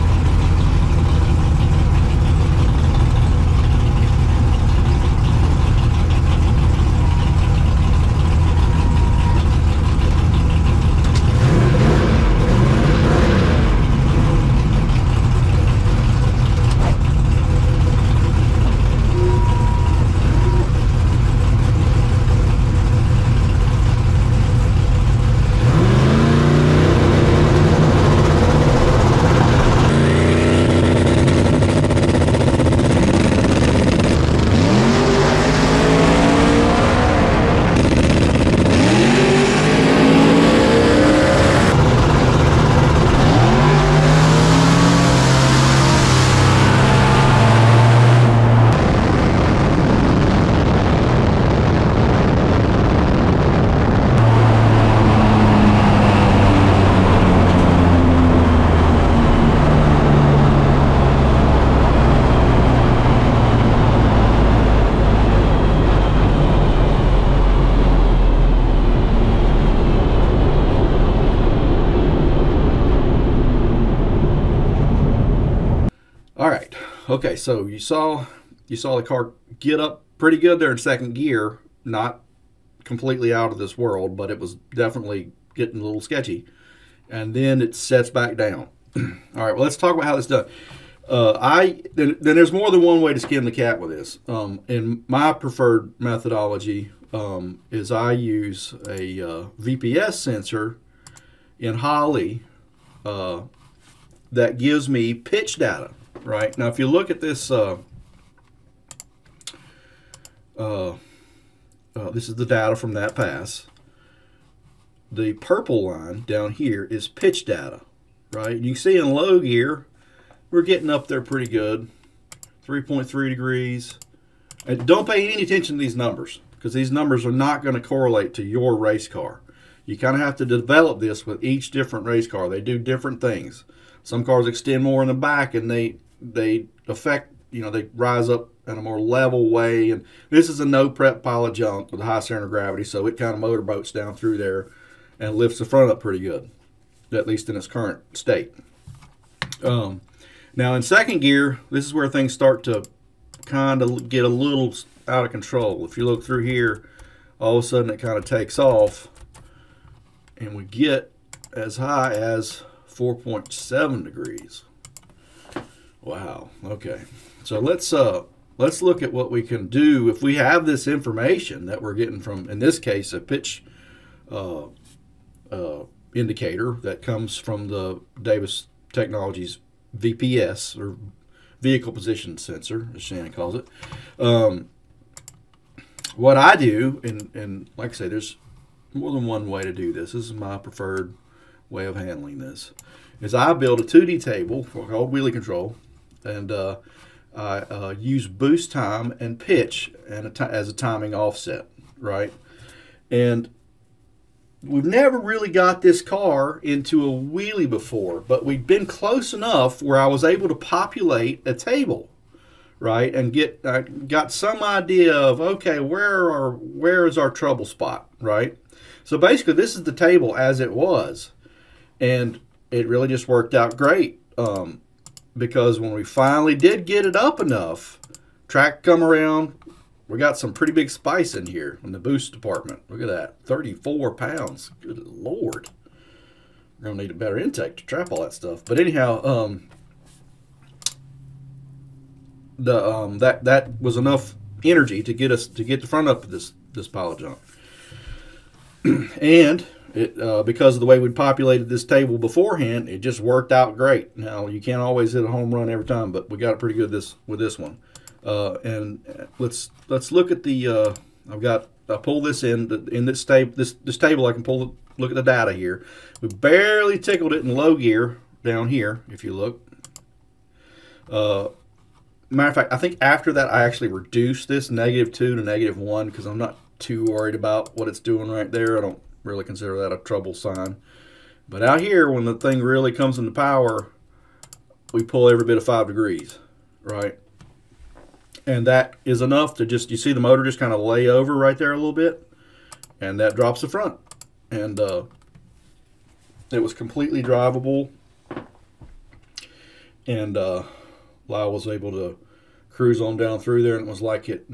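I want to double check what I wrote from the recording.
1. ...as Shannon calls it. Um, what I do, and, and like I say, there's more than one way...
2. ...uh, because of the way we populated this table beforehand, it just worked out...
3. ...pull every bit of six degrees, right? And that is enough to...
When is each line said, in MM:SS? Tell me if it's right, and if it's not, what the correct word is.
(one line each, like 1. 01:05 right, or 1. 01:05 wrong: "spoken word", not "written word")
1. 03:02 right
2. 04:10 right
3. 04:45 wrong: "five", not "six".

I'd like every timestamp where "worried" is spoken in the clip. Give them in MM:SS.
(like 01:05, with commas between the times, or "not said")
04:37.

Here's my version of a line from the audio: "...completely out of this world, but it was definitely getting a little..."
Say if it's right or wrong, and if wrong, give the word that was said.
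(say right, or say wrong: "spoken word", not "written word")
right.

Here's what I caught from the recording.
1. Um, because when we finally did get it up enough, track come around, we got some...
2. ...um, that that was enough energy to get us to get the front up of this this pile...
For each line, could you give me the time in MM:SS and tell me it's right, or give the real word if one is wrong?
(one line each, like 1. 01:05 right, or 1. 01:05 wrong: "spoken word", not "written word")
1. 03:44 right
2. 04:02 right.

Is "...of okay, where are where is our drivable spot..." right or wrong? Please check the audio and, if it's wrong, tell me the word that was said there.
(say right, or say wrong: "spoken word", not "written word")
wrong: "trouble", not "drivable".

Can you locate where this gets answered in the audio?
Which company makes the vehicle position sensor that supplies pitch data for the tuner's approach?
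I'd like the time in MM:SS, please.
02:58.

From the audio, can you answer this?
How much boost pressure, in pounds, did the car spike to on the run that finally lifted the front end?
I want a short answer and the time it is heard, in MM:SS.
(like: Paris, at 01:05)
34 pounds, at 03:53.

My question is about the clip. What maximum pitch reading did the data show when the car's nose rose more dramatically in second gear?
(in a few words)
4.7 degrees.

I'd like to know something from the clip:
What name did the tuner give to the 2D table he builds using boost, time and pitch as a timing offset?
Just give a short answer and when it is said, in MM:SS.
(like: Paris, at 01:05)
wheelie control, at 03:15.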